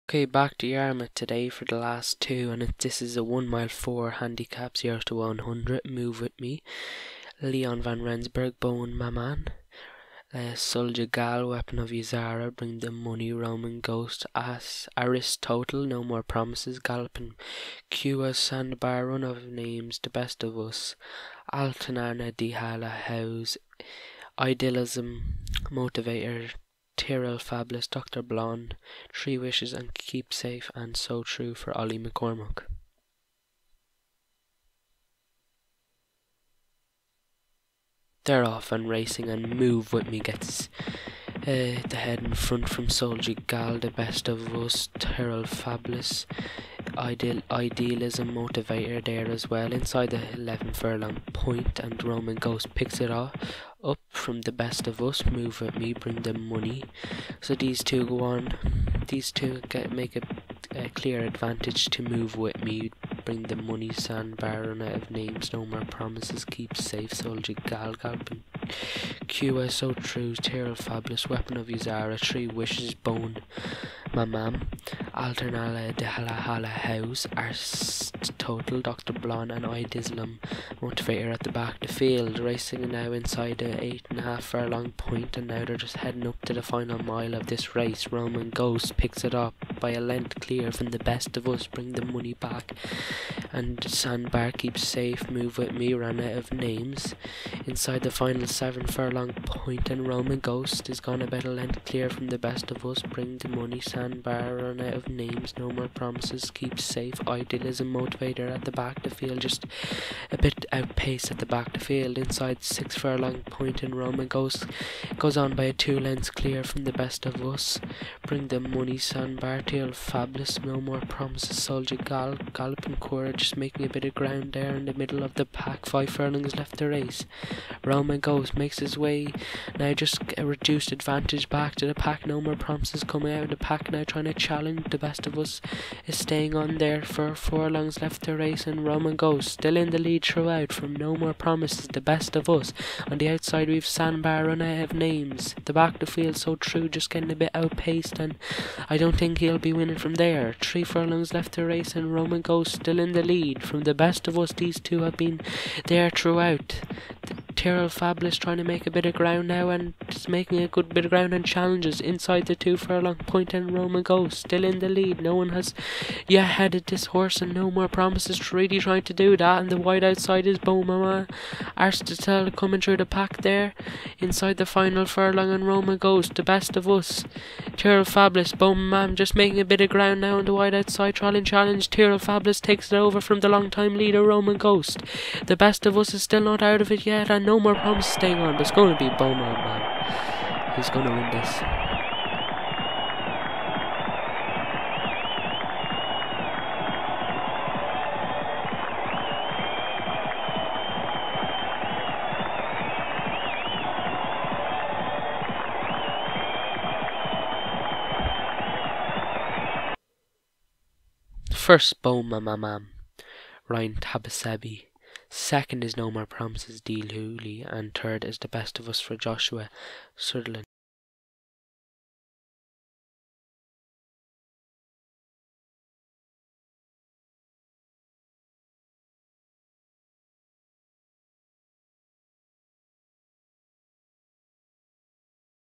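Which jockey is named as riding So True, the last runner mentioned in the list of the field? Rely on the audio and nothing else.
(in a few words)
Ollie McCormack.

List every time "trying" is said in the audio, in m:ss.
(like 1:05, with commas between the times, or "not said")
2:14, 2:38, 2:48.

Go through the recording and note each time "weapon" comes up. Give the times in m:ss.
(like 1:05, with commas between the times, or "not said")
0:11, 1:11.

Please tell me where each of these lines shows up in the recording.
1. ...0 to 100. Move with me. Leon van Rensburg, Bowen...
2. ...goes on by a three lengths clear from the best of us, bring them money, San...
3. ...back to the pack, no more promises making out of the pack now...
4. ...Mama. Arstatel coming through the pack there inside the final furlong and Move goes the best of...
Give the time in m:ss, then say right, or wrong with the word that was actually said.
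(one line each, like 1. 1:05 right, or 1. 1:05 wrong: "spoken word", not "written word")
1. 0:04 right
2. 1:55 wrong: "two", not "three"
3. 2:11 wrong: "coming", not "making"
4. 2:50 wrong: "Roma", not "Move".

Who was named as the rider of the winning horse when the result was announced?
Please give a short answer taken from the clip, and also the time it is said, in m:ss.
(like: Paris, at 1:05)
Ryan Tabasebi, at 3:33.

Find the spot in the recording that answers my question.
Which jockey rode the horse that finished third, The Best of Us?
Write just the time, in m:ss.
3:39.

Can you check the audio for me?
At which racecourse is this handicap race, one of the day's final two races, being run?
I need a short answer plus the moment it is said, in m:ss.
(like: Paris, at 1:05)
Yarmouth, at 0:00.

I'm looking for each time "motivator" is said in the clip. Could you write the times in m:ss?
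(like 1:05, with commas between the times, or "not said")
0:25, 0:48, 1:20, 1:47.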